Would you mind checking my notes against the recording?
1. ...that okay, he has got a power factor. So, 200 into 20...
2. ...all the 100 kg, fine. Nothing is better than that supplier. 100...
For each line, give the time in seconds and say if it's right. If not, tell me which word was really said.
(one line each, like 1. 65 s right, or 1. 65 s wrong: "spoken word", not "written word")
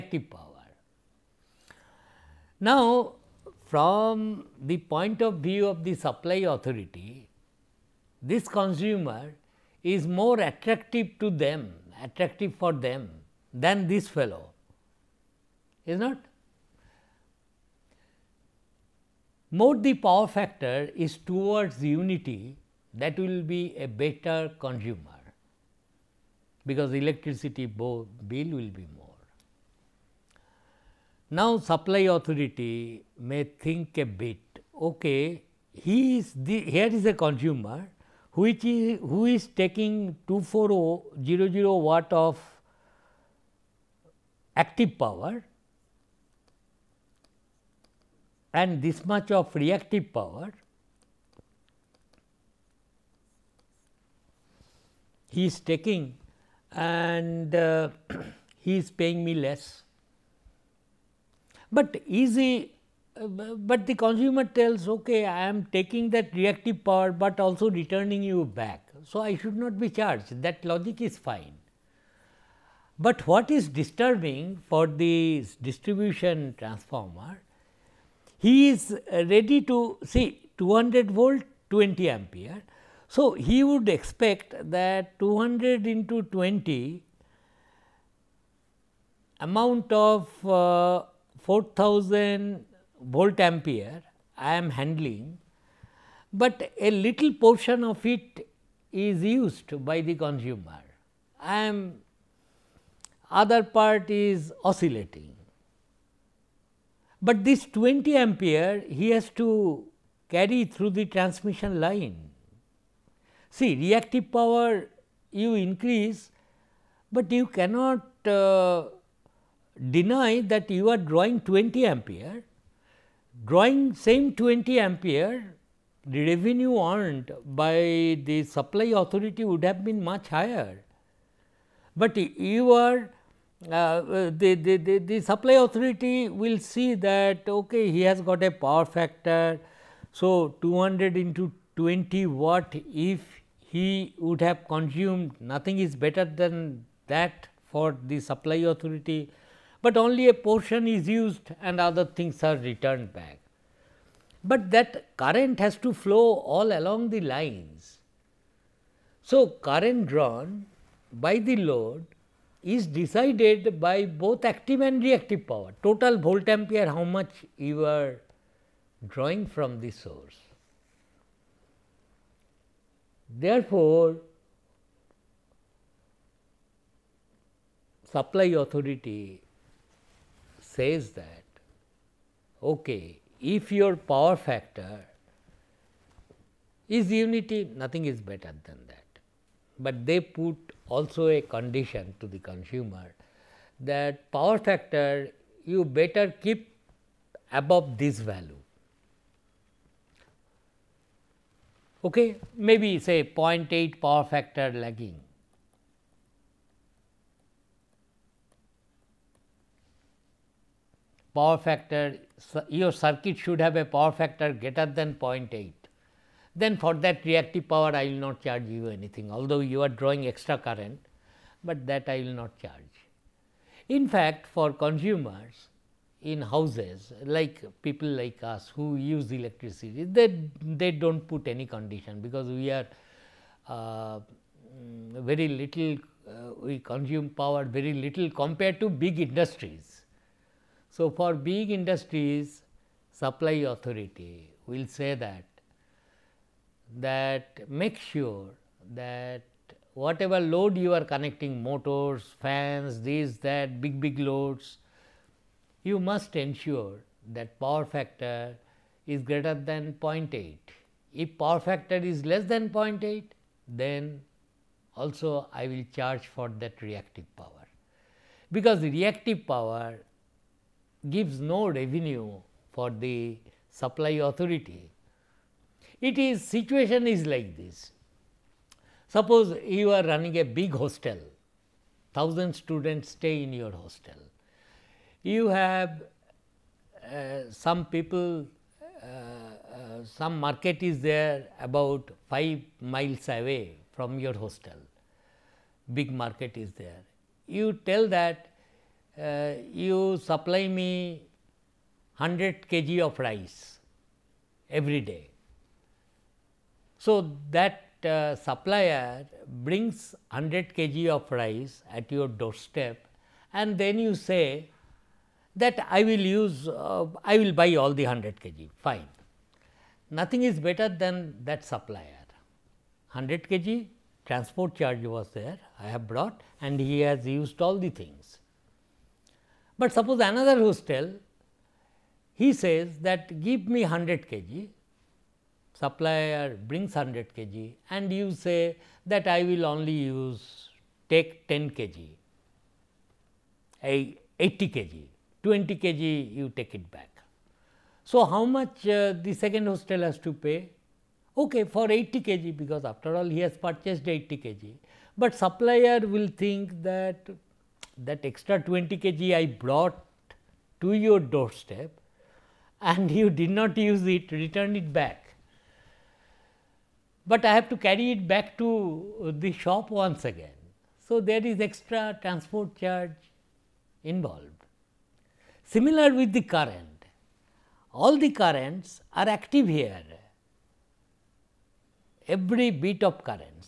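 1. 136 s right
2. 317 s right.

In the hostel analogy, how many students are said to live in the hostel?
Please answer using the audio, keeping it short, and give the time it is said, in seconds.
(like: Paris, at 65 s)
1000, at 282 s.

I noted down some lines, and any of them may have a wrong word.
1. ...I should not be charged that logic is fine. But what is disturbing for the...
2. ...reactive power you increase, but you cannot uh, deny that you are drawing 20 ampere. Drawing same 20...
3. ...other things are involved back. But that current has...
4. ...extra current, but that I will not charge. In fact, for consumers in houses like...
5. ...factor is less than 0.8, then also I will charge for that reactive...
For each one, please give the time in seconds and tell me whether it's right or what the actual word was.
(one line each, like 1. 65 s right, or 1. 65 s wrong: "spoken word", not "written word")
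1. 69 s right
2. 113 s right
3. 151 s wrong: "returned", not "involved"
4. 220 s right
5. 261 s right.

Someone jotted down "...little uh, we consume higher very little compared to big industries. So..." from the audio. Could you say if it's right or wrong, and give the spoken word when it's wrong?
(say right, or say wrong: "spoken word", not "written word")
wrong: "power", not "higher".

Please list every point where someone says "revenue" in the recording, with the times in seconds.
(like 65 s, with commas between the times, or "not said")
126 s, 271 s.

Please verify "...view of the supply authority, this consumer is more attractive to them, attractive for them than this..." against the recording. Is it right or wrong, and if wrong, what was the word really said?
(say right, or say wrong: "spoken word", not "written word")
right.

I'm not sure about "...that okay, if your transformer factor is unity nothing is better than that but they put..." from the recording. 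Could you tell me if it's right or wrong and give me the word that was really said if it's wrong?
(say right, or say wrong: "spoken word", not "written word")
wrong: "power", not "transformer".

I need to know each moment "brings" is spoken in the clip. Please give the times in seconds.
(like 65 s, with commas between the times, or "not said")
309 s, 336 s.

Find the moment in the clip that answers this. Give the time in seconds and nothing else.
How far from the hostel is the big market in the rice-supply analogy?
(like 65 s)
292 s.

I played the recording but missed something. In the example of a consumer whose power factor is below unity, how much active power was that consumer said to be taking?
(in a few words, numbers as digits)
24000 watts.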